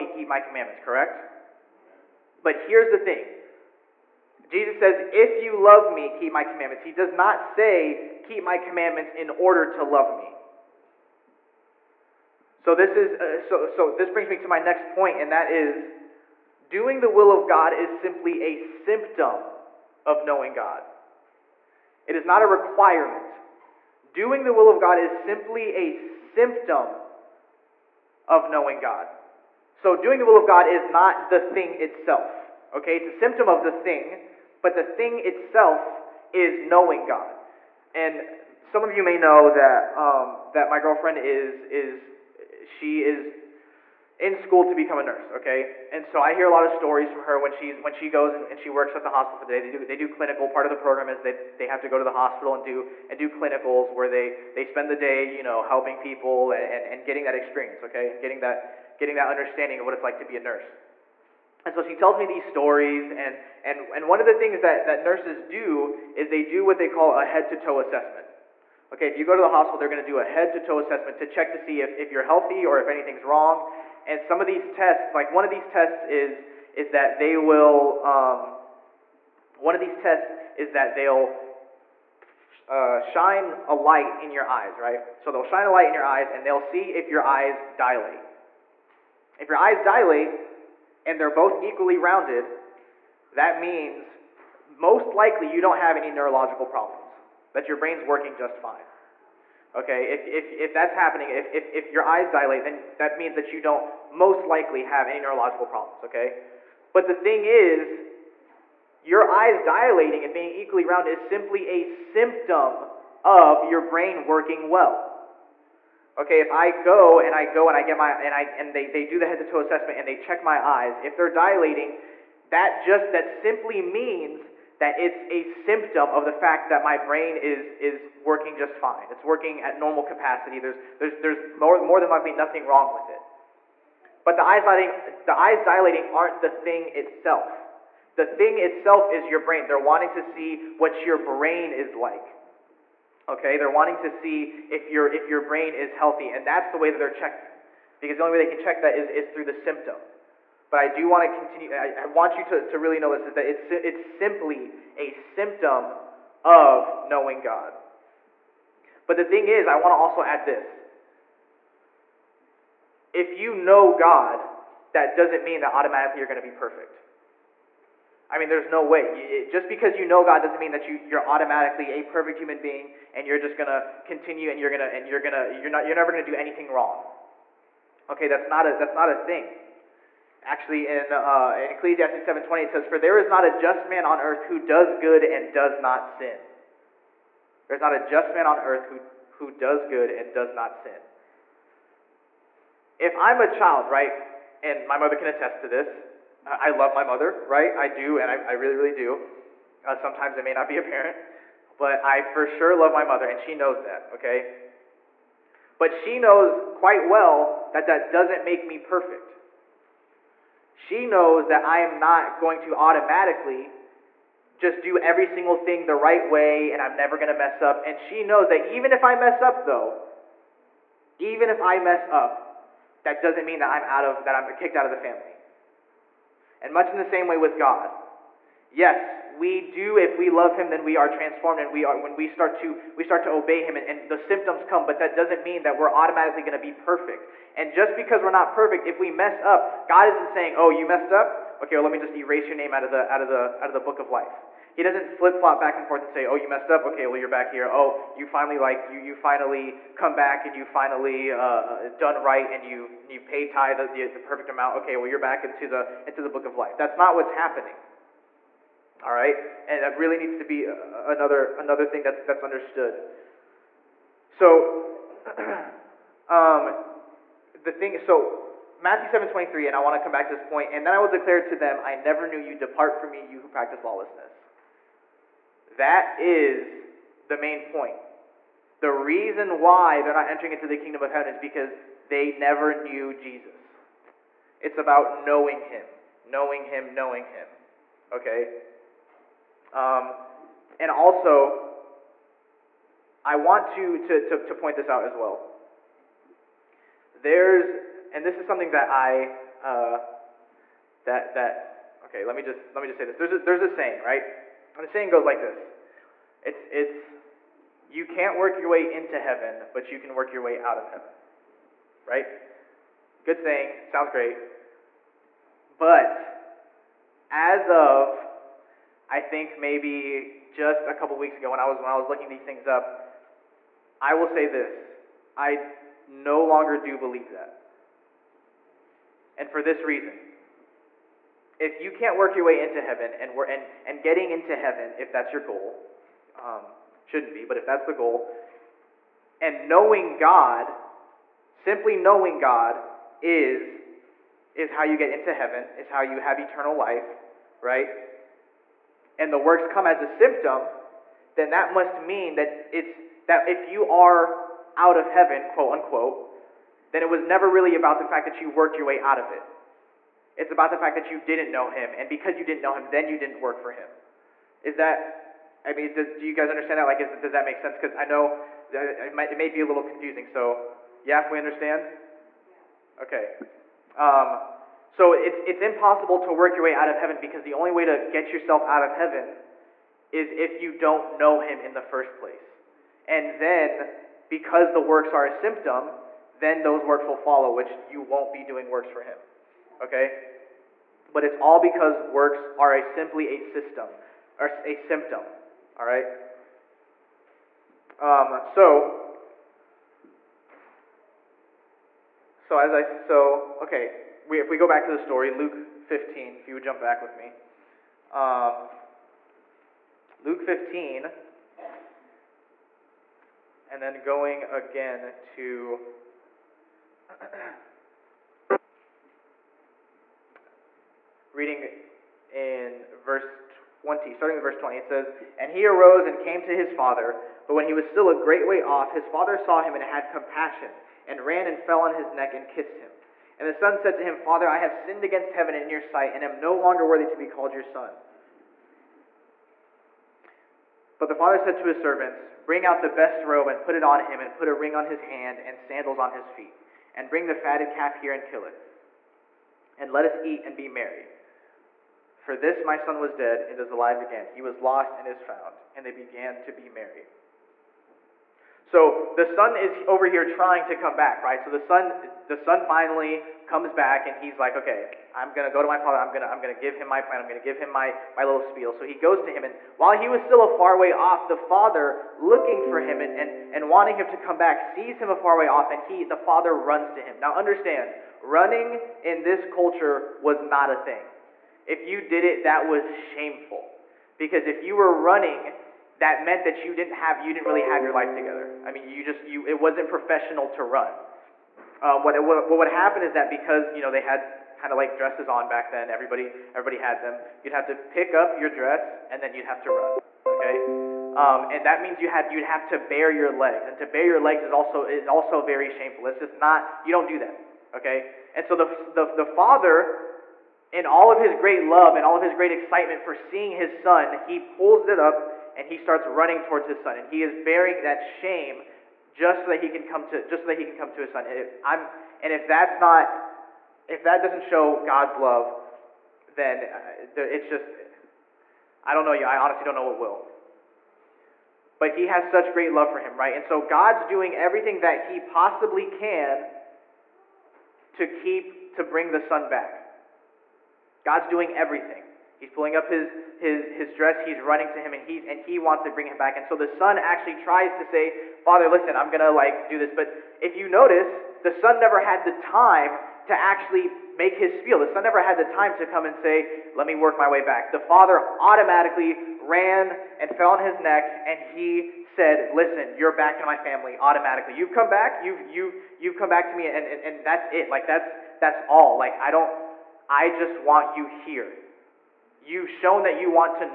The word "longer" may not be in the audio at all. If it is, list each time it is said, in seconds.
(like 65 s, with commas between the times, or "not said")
326 s, 436 s.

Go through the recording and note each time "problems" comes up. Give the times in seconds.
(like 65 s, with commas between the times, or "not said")
96 s, 105 s.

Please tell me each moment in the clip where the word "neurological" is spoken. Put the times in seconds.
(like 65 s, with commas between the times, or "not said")
96 s, 105 s.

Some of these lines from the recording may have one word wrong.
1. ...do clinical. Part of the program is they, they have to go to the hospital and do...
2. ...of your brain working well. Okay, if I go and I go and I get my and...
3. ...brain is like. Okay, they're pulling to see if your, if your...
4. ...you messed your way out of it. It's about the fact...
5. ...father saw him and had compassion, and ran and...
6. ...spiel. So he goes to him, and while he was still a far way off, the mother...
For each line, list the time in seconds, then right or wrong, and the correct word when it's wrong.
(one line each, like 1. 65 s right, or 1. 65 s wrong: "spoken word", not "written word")
1. 49 s right
2. 113 s right
3. 141 s wrong: "wanting", not "pulling"
4. 358 s wrong: "worked", not "messed"
5. 429 s right
6. 468 s wrong: "father", not "mother".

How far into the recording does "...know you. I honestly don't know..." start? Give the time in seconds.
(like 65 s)
529 s.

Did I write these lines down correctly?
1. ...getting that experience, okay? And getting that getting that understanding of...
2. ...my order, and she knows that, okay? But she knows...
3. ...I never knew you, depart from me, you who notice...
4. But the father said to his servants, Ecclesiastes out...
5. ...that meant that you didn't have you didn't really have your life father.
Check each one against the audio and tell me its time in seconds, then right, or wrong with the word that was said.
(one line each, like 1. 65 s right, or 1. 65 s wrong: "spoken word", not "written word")
1. 57 s right
2. 202 s wrong: "mother", not "order"
3. 271 s wrong: "practice", not "notice"
4. 440 s wrong: "Bring", not "Ecclesiastes"
5. 486 s wrong: "together", not "father".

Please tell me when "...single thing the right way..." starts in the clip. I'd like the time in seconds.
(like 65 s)
215 s.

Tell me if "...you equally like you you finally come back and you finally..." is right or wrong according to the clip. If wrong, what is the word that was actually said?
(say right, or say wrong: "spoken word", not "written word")
wrong: "finally", not "equally".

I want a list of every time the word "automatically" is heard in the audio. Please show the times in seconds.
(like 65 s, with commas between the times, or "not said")
165 s, 171 s, 212 s, 235 s, 558 s, 563 s.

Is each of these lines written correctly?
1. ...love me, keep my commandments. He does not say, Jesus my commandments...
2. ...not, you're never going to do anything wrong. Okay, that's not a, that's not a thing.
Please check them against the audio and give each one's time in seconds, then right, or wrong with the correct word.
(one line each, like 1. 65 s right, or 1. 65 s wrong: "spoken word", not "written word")
1. 5 s wrong: "Keep", not "Jesus"
2. 175 s right.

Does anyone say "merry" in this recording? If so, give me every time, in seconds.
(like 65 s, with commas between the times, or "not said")
450 s, 456 s.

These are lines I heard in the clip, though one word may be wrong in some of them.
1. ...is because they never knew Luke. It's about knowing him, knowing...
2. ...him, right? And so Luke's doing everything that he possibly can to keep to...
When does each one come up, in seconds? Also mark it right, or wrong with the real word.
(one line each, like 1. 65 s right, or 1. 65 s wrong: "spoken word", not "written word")
1. 281 s wrong: "Jesus", not "Luke"
2. 532 s wrong: "God", not "Luke".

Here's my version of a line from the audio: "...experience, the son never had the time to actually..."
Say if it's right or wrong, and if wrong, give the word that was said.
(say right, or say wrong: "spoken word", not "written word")
wrong: "notice", not "experience".